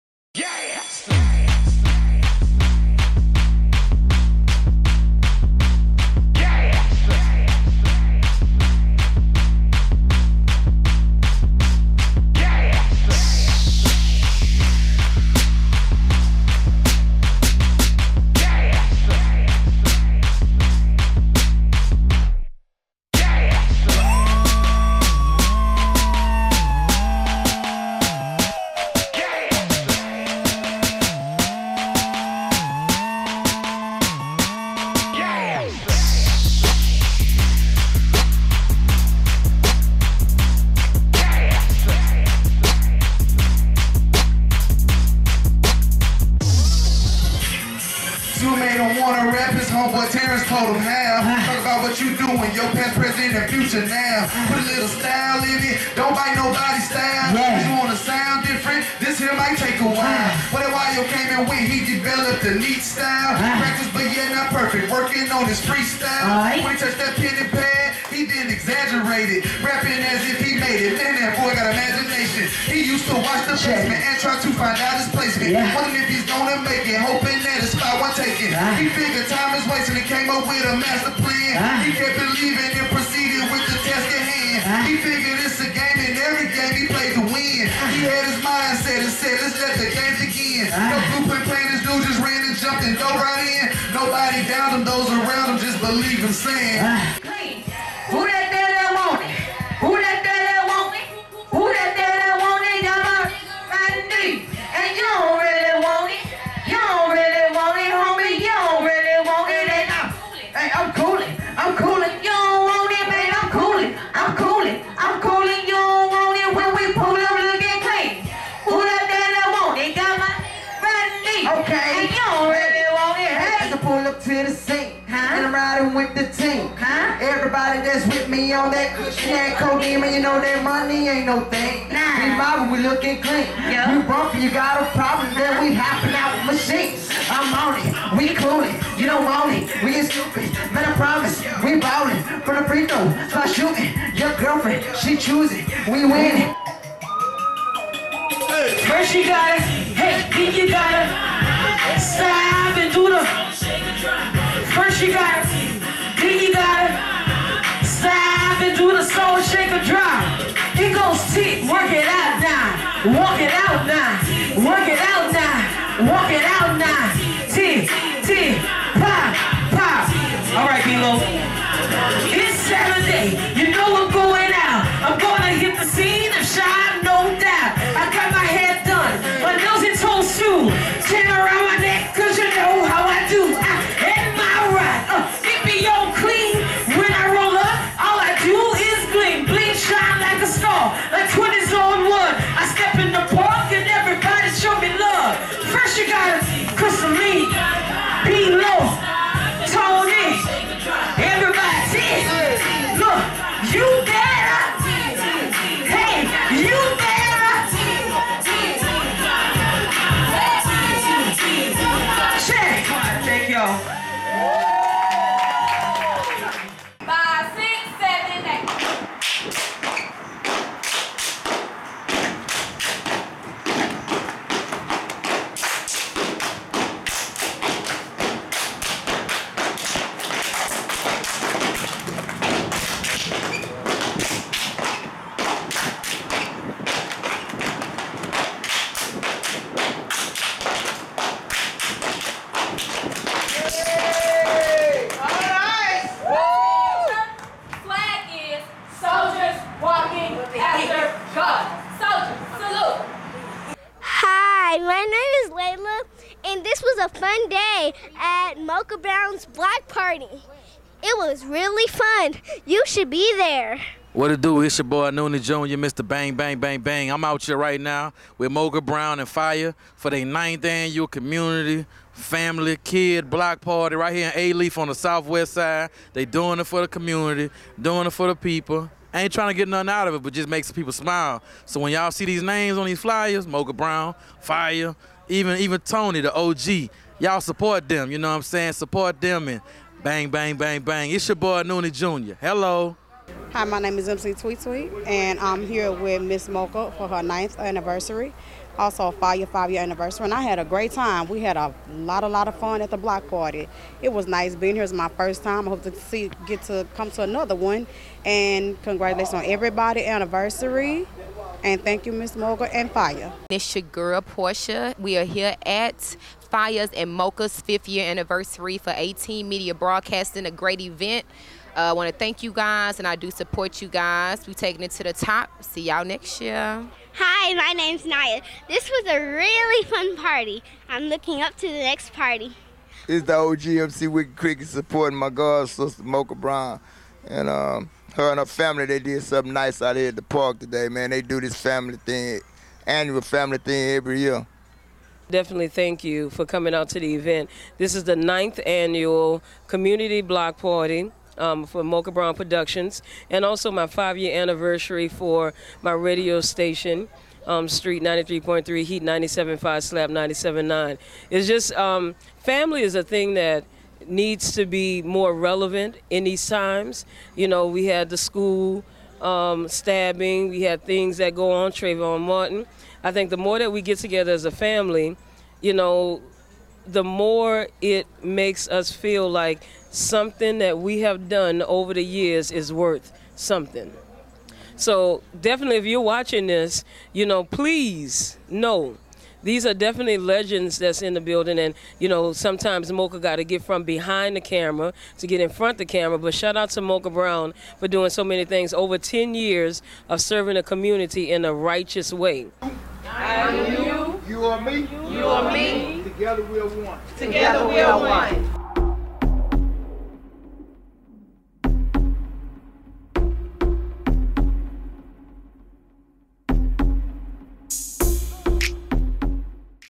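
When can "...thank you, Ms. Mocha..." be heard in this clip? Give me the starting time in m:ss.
5:11.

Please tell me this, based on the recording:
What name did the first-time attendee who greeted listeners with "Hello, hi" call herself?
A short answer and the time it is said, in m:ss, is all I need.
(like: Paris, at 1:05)
MC Tweet Tweet, at 4:54.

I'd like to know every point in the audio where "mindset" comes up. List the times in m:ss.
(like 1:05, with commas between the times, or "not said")
1:28.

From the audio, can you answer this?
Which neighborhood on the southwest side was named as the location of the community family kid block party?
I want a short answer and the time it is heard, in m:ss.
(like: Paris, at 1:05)
Alief, at 4:34.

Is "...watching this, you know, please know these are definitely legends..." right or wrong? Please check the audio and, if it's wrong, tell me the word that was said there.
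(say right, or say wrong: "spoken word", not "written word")
right.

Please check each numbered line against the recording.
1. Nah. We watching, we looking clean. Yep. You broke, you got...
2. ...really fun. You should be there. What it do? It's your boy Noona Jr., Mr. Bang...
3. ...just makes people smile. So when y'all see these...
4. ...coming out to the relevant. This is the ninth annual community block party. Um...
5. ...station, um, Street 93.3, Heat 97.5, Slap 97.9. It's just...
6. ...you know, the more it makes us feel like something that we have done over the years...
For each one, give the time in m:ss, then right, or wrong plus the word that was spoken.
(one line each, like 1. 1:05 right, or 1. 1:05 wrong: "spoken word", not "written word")
1. 2:11 wrong: "mobbing", not "watching"
2. 4:21 right
3. 4:40 right
4. 5:46 wrong: "event", not "relevant"
5. 5:56 right
6. 6:15 right.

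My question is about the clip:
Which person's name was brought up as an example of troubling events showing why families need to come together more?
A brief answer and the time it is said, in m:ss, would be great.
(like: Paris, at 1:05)
Trayvon Martin, at 6:11.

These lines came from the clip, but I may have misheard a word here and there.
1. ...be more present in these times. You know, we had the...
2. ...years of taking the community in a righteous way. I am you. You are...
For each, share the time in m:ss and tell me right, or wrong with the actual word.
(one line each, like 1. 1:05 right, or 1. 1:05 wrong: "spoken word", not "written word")
1. 6:04 wrong: "relevant", not "present"
2. 6:39 wrong: "serving", not "taking".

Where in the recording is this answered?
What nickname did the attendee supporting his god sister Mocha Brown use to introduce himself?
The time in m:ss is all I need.
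5:33.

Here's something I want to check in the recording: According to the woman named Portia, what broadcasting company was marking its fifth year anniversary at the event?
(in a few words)
18 Media Broadcasting.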